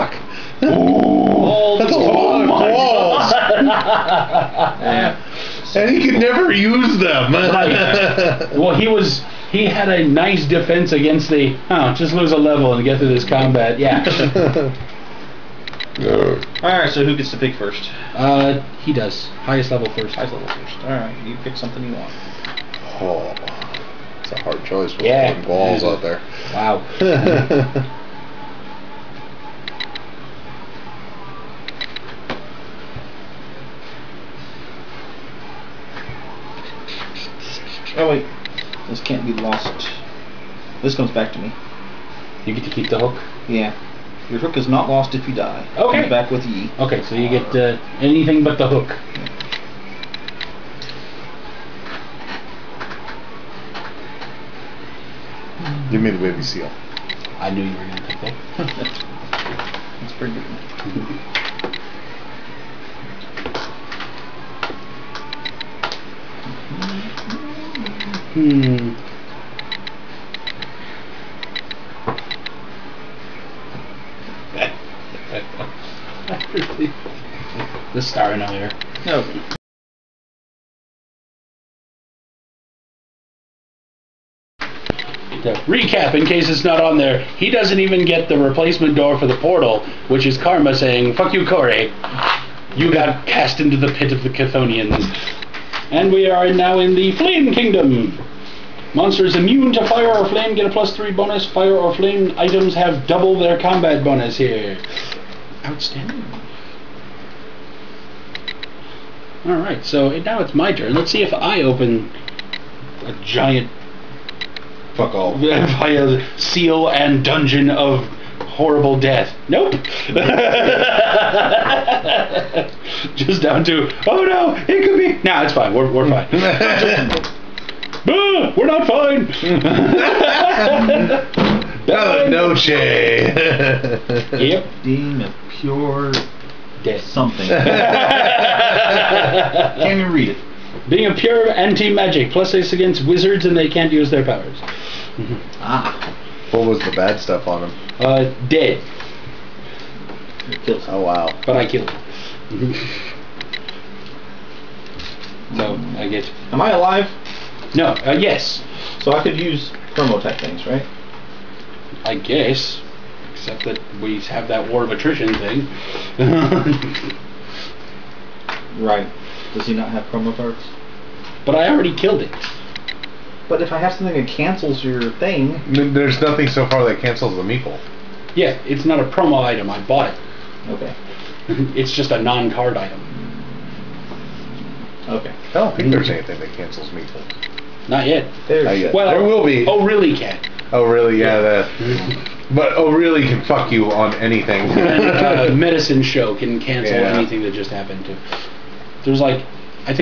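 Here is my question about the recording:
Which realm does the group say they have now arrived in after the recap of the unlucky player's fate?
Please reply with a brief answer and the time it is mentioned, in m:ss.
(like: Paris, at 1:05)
Flame Kingdom, at 1:37.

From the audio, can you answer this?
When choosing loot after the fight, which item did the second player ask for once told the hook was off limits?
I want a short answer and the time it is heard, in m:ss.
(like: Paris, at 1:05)
The baby seal, at 0:56.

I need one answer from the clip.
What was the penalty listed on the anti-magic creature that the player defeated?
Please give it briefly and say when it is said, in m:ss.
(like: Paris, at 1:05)
Dead, at 2:28.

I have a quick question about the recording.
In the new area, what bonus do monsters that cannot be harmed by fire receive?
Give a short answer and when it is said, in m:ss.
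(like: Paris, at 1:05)
+3, at 1:40.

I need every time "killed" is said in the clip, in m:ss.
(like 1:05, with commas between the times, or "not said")
2:31, 2:51.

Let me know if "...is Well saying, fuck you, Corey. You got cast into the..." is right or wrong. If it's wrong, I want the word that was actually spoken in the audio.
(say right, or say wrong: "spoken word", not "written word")
wrong: "Karma", not "Well".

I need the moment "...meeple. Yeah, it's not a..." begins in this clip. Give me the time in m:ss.
2:57.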